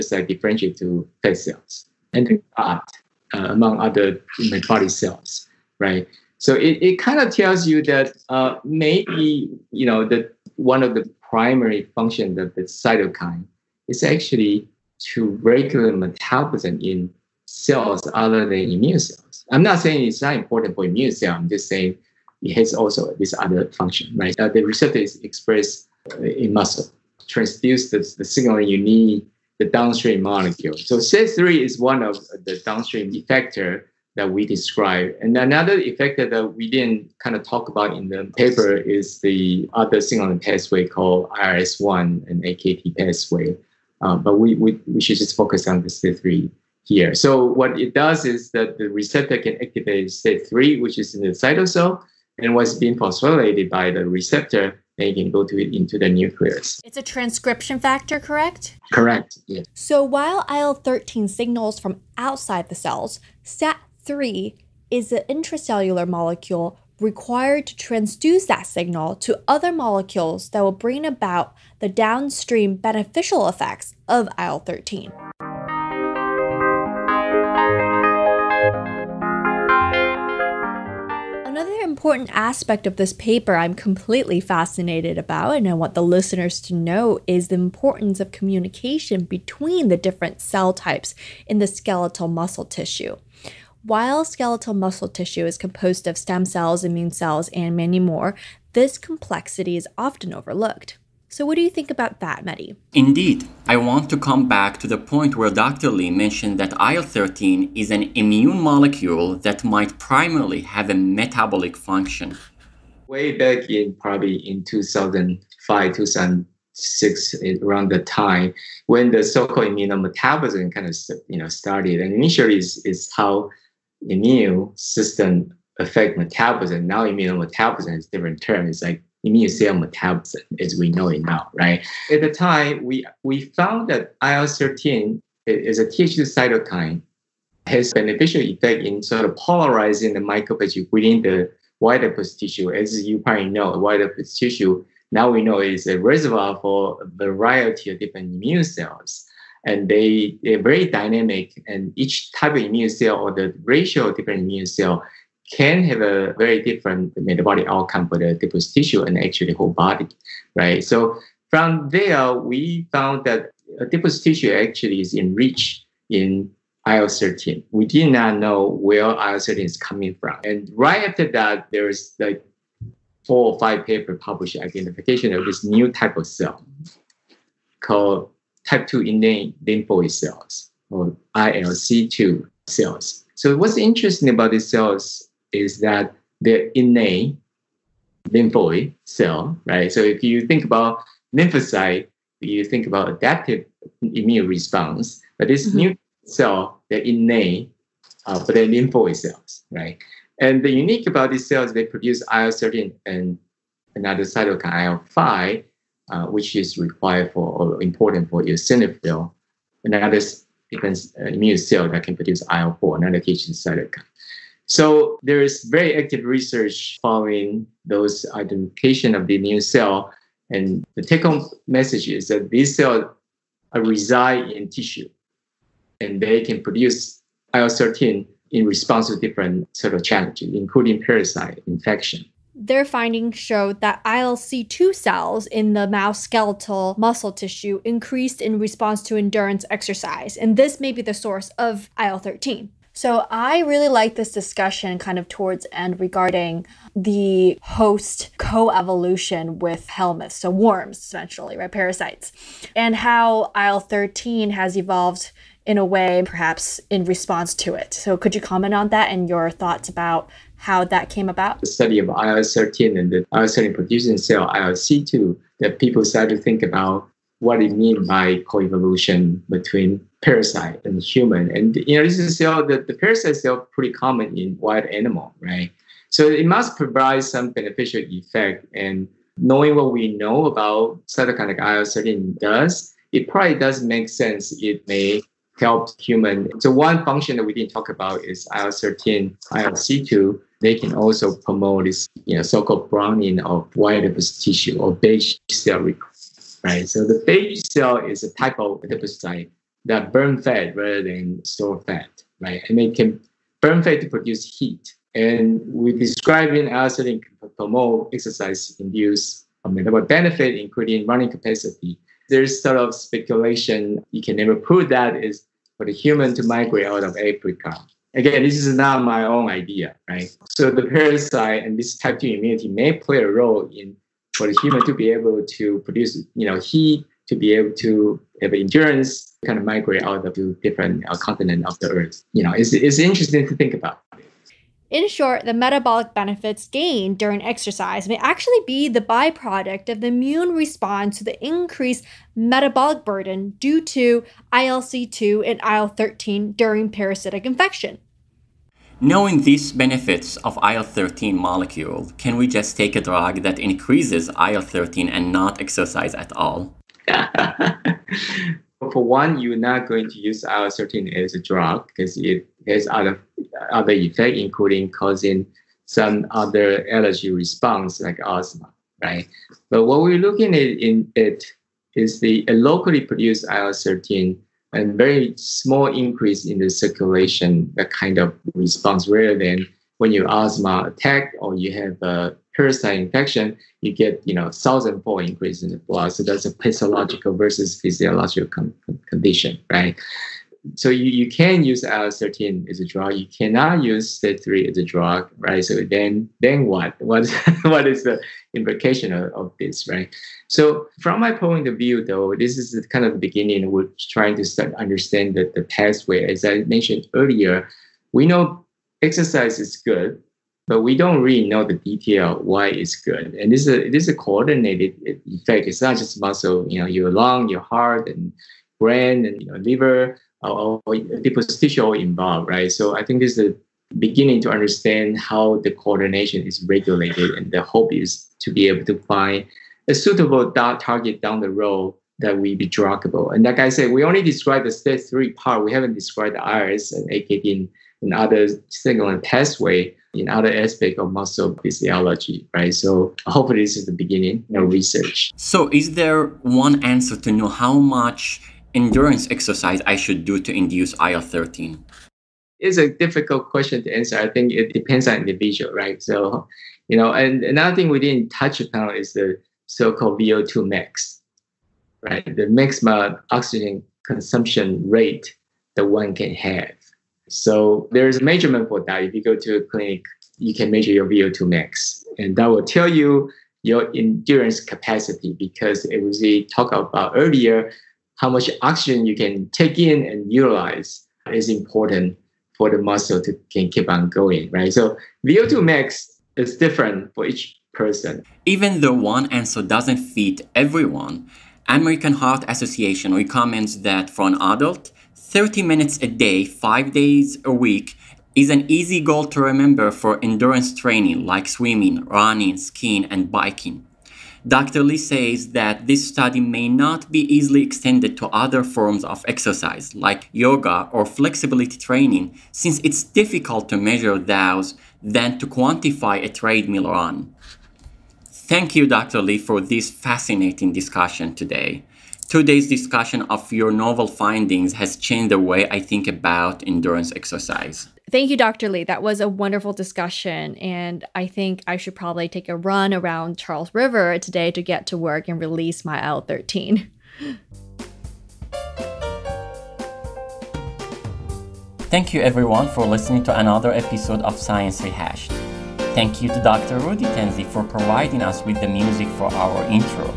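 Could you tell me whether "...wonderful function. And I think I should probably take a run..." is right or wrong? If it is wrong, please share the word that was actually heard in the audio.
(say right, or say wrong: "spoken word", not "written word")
wrong: "discussion", not "function".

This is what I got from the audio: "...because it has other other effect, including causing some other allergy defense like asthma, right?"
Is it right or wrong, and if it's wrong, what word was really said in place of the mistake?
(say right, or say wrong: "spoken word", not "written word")
wrong: "response", not "defense".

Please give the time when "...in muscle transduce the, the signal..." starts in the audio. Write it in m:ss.
0:26.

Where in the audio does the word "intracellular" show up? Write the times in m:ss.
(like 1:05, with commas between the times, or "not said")
1:05.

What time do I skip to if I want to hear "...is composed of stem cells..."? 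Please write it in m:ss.
1:35.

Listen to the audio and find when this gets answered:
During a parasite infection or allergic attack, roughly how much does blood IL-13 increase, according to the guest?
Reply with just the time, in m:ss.
6:24.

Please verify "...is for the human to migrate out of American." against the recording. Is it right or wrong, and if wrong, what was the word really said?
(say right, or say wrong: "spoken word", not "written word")
wrong: "Africa", not "American".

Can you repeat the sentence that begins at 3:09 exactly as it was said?
So if you think about lymphocyte, you think about adaptive immune response, but this mm-hmm.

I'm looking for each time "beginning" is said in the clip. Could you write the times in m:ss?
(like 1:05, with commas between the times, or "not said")
6:43, 7:03, 7:23.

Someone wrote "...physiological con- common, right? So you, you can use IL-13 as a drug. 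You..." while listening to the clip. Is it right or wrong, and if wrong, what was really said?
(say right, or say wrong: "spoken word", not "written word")
wrong: "condition", not "common".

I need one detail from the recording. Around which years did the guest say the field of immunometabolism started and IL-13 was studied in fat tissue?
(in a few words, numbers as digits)
2005, 2006.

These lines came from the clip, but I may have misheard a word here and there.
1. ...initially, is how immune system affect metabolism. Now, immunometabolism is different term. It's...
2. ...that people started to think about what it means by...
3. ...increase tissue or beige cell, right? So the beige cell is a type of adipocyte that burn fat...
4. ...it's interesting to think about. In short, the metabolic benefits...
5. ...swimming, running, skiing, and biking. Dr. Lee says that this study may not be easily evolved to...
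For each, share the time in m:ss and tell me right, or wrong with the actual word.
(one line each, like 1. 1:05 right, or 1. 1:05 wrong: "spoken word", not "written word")
1. 2:02 right
2. 4:25 right
3. 4:54 wrong: "adipose", not "increase"
4. 5:32 right
5. 8:21 wrong: "extended", not "evolved".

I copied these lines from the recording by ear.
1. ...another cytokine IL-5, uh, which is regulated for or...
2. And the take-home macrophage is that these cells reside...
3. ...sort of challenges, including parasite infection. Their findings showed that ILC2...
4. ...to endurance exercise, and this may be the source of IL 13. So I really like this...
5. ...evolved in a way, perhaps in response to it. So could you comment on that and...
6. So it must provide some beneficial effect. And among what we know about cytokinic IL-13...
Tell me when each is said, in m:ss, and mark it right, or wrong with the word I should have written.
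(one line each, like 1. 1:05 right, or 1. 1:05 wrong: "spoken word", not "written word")
1. 3:23 wrong: "required", not "regulated"
2. 3:40 wrong: "message", not "macrophage"
3. 3:49 right
4. 3:59 right
5. 4:14 right
6. 4:36 wrong: "knowing", not "among".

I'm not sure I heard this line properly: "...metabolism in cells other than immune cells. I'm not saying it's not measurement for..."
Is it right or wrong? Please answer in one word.
wrong.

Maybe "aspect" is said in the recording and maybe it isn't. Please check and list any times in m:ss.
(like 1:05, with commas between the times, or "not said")
1:22, 7:20.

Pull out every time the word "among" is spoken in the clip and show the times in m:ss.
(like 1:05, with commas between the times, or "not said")
0:03.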